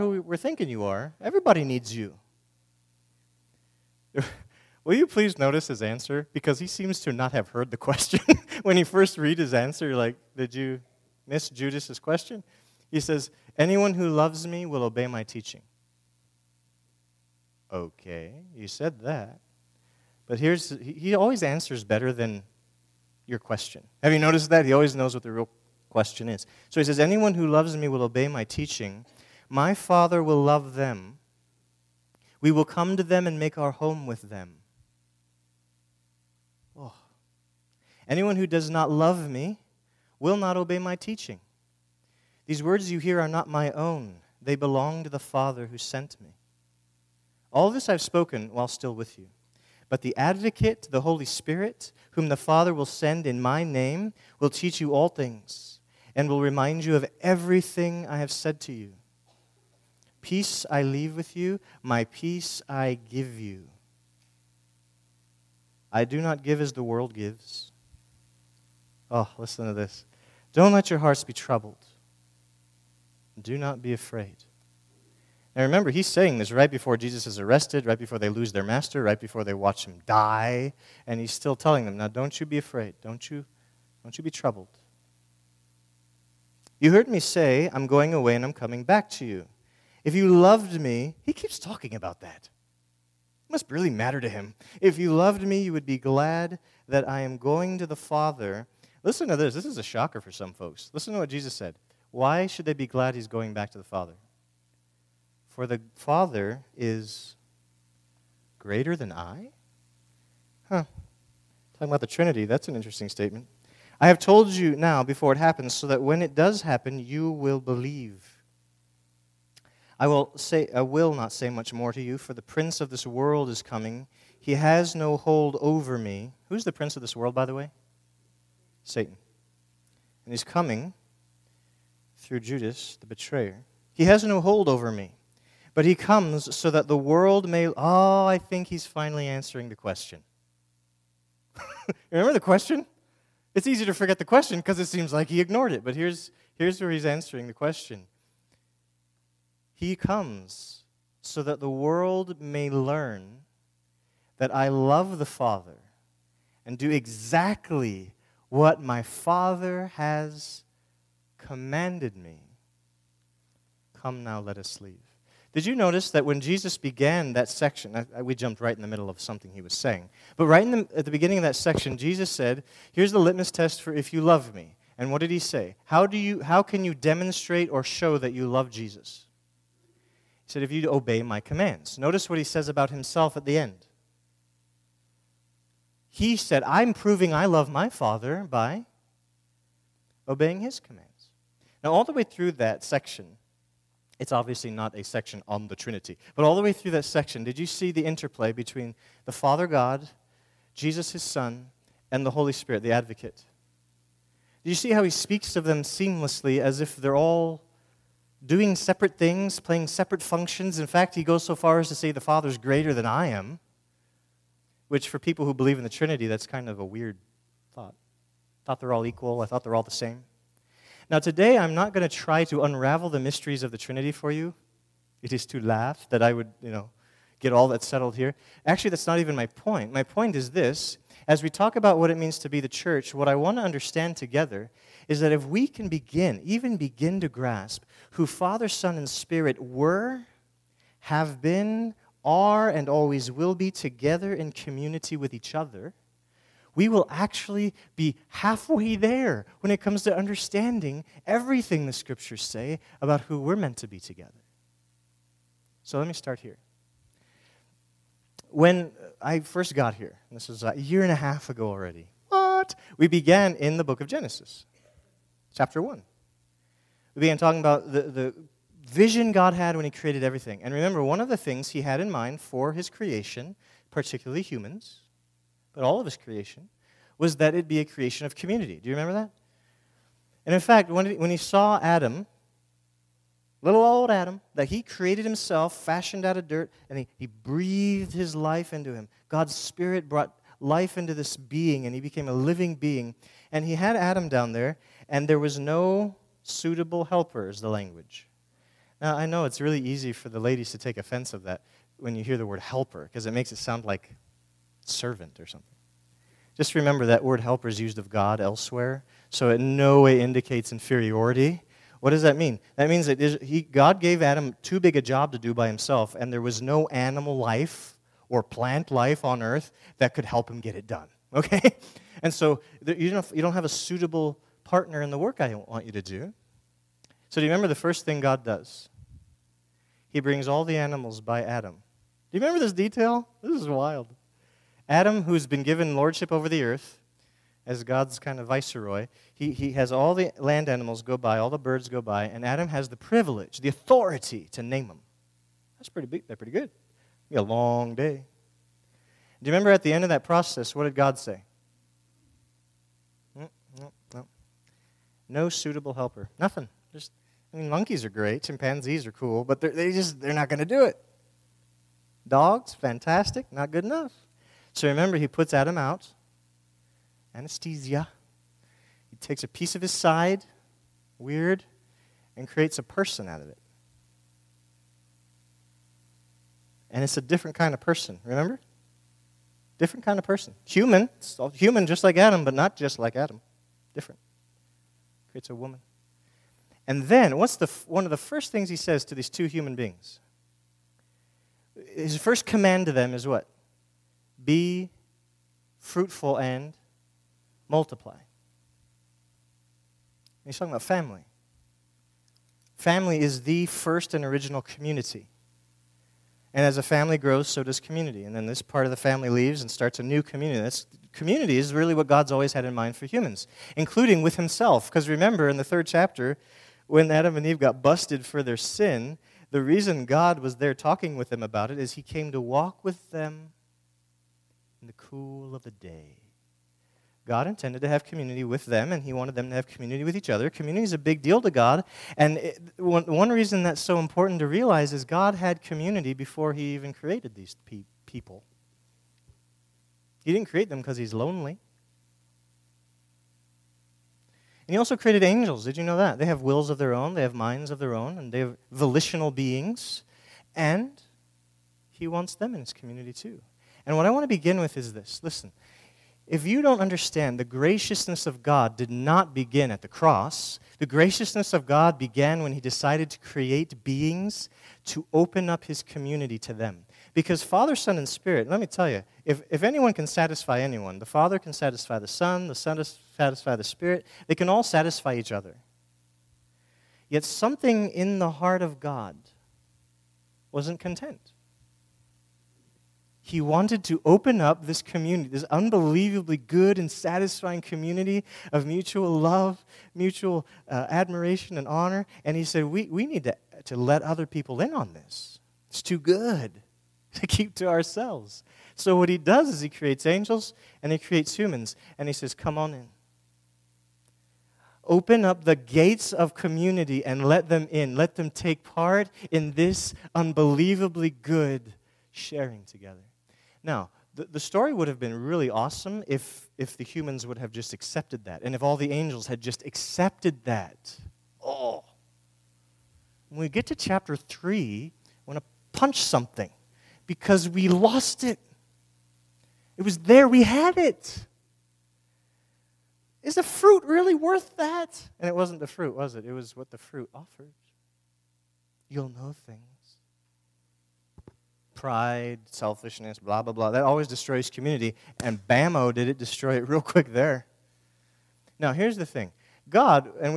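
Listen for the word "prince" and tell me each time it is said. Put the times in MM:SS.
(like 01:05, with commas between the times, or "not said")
02:02, 02:06.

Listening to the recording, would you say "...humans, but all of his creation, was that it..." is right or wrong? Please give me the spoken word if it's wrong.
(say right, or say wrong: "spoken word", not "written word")
right.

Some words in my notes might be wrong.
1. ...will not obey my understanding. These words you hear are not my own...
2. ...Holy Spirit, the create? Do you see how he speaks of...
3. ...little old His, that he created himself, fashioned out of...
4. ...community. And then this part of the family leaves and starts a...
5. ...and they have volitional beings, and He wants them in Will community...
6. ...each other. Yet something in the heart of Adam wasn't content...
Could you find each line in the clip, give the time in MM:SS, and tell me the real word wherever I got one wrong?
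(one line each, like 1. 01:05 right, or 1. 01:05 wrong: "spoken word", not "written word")
1. 00:40 wrong: "teaching", not "understanding"
2. 03:22 wrong: "advocate", not "create"
3. 04:43 wrong: "Adam", not "His"
4. 06:47 right
5. 07:28 wrong: "His", not "Will"
6. 07:55 wrong: "God", not "Adam".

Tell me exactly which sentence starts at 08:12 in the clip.
And he said, we, we need to, to let other people in on this.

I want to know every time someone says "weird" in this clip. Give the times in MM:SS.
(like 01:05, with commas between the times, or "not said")
03:36, 06:11.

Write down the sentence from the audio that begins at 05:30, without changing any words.
He brings all the animals by Adam.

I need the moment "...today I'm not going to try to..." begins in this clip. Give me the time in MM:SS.
03:41.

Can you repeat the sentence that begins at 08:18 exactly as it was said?
So, what he does is he creates angels and he creates humans.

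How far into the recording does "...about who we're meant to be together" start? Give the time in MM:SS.
04:13.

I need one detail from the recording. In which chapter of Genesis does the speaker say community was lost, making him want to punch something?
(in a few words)
Chapter 3.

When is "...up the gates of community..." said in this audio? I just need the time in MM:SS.
08:25.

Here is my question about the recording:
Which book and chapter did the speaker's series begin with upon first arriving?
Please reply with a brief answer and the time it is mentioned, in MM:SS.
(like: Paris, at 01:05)
Genesis chapter 1, at 04:24.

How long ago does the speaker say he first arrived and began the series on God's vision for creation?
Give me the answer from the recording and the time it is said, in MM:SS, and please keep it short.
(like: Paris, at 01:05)
A year and a half, at 04:20.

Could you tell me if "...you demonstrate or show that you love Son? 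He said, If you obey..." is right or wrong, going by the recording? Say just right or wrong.
wrong.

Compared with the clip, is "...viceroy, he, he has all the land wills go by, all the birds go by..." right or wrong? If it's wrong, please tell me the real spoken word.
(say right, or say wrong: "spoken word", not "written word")
wrong: "animals", not "wills".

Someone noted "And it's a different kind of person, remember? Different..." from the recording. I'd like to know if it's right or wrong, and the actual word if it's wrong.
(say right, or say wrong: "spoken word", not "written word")
right.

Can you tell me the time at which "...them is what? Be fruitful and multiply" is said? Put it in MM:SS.
06:32.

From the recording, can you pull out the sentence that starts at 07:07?
God intended to have community with them, and He wanted them to have community with each other.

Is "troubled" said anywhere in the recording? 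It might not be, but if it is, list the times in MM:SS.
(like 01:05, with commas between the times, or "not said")
01:11, 01:24.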